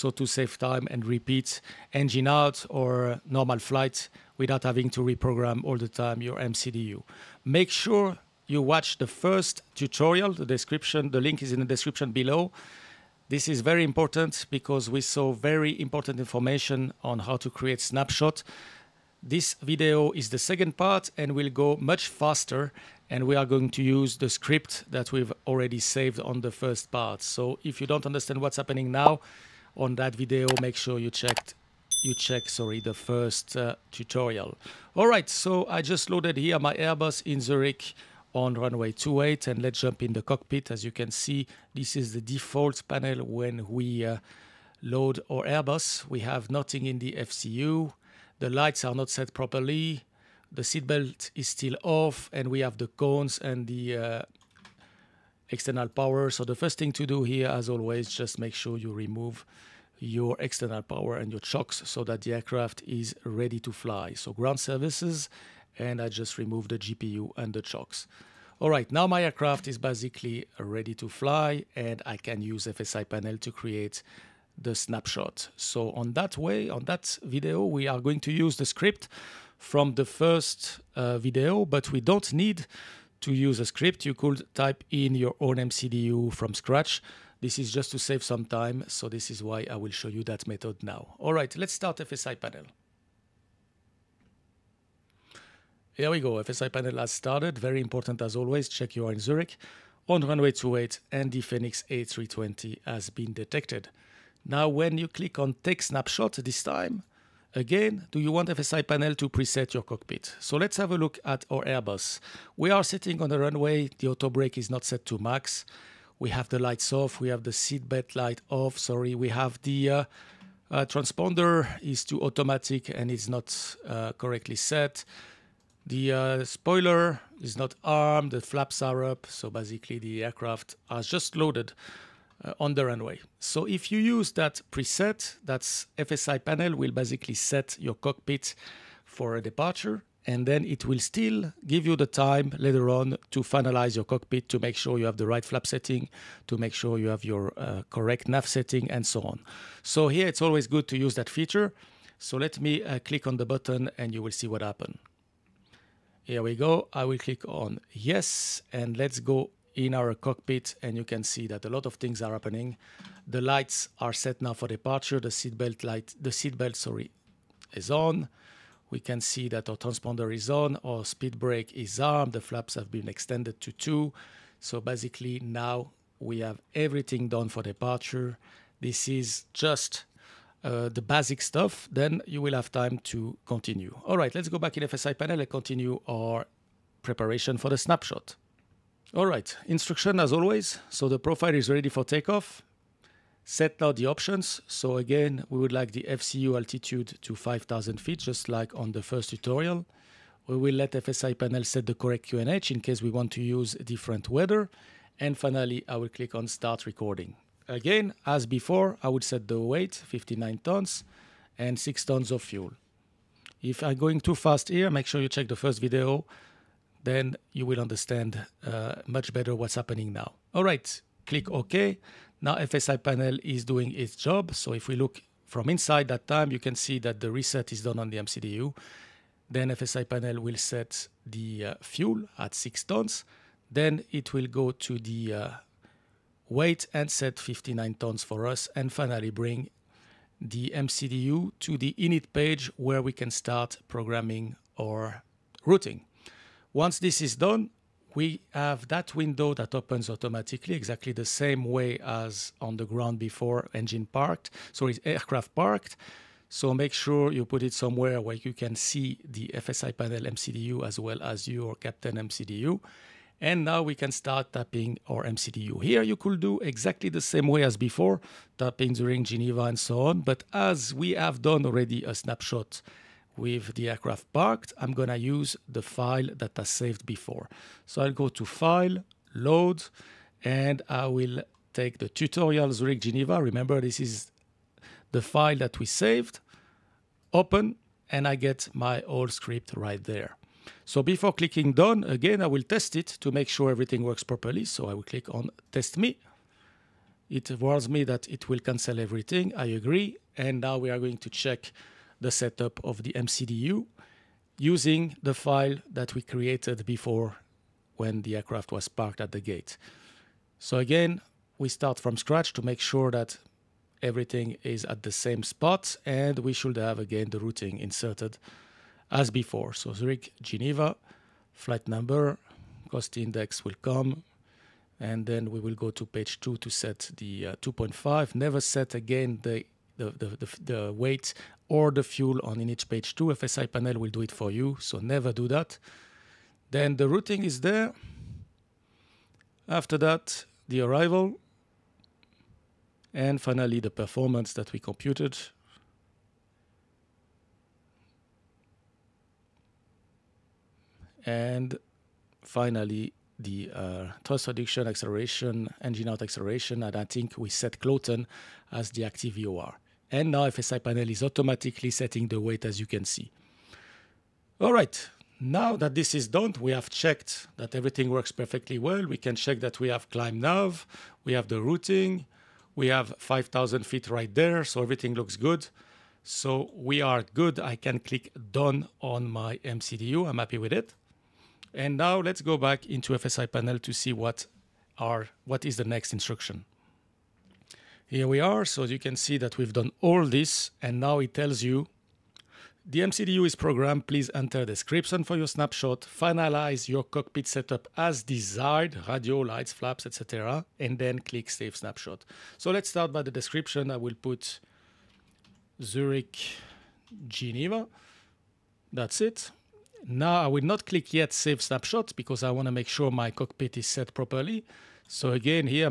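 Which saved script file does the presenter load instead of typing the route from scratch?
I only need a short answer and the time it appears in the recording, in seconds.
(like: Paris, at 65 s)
tutorial Zurich Geneva, at 282 s.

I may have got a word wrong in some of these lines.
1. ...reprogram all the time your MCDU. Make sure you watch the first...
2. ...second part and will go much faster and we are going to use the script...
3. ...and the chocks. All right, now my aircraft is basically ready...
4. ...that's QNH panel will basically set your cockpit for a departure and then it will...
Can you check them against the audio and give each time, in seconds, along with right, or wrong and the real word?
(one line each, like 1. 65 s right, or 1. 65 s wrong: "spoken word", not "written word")
1. 5 s right
2. 20 s right
3. 67 s right
4. 135 s wrong: "FSI", not "QNH".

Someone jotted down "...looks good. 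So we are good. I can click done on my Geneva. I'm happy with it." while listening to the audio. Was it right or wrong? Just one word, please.
wrong.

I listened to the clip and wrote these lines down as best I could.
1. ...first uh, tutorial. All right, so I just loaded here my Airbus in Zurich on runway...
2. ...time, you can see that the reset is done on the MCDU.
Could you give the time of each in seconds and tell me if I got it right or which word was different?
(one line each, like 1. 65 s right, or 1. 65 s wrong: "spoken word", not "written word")
1. 32 s right
2. 226 s right.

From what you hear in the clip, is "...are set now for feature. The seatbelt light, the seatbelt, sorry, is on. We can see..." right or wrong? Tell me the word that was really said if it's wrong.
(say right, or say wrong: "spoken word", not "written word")
wrong: "departure", not "feature".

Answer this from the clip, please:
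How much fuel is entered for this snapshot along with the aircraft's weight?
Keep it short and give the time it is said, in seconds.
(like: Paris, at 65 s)
6 tons, at 211 s.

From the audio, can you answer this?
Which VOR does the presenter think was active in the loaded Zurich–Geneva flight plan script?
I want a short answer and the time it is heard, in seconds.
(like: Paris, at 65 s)
Kloten, at 357 s.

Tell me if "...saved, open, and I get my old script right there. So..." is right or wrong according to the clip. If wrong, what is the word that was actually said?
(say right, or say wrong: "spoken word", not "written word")
right.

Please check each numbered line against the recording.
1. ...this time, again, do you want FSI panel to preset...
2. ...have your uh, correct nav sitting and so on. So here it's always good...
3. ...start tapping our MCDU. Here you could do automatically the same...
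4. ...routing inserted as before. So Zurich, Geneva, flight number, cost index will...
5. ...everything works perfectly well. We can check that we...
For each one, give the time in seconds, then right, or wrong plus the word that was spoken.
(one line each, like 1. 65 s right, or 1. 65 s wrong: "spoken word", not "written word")
1. 106 s right
2. 147 s wrong: "setting", not "sitting"
3. 264 s wrong: "exactly", not "automatically"
4. 317 s right
5. 367 s right.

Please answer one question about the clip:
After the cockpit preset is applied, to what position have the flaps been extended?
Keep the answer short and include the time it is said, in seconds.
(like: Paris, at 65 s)
2, at 173 s.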